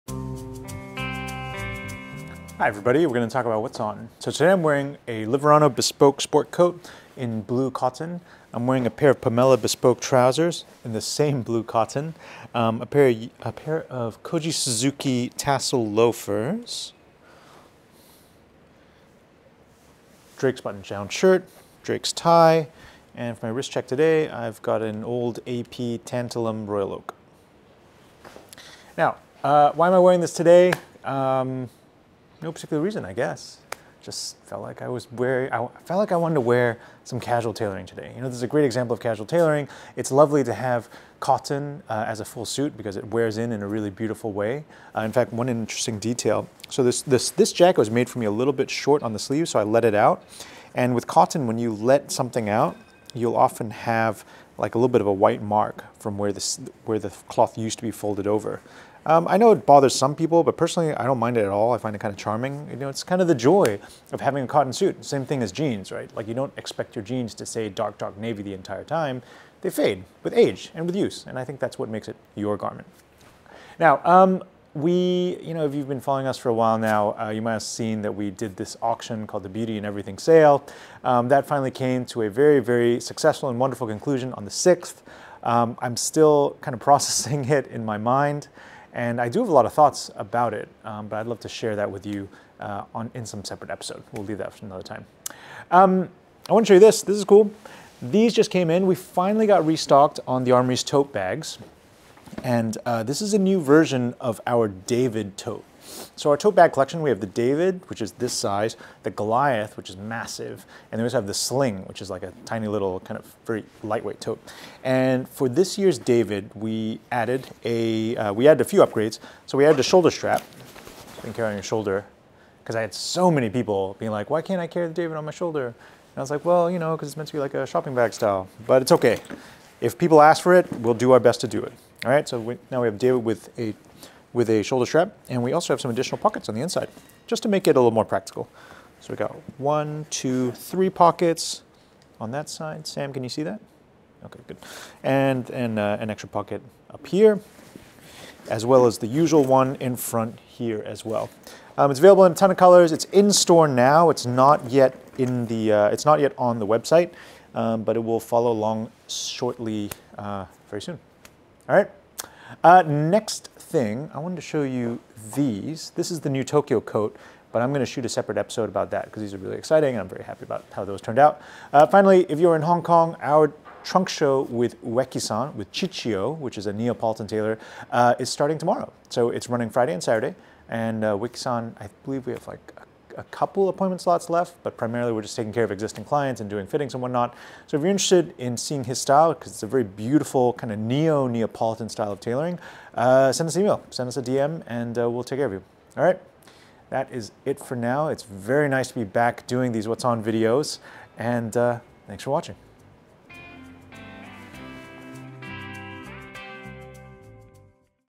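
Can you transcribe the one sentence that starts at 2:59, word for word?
So it's running Friday and Saturday.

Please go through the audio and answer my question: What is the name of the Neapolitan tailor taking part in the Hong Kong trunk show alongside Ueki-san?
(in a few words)
Ciccio.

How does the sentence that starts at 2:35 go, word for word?
Uh, it's not yet on the website, um, but it will follow along shortly, uh, very soon.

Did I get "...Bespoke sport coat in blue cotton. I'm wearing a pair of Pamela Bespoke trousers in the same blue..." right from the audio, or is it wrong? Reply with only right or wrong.
right.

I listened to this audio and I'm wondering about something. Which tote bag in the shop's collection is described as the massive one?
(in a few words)
Goliath.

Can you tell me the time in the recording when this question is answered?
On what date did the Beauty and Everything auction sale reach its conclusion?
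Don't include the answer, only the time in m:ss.
1:24.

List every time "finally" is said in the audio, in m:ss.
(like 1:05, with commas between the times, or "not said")
1:21, 1:38, 2:51.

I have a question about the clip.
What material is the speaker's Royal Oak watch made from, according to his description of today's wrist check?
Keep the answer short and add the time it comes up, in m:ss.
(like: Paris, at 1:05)
Tantalum, at 0:26.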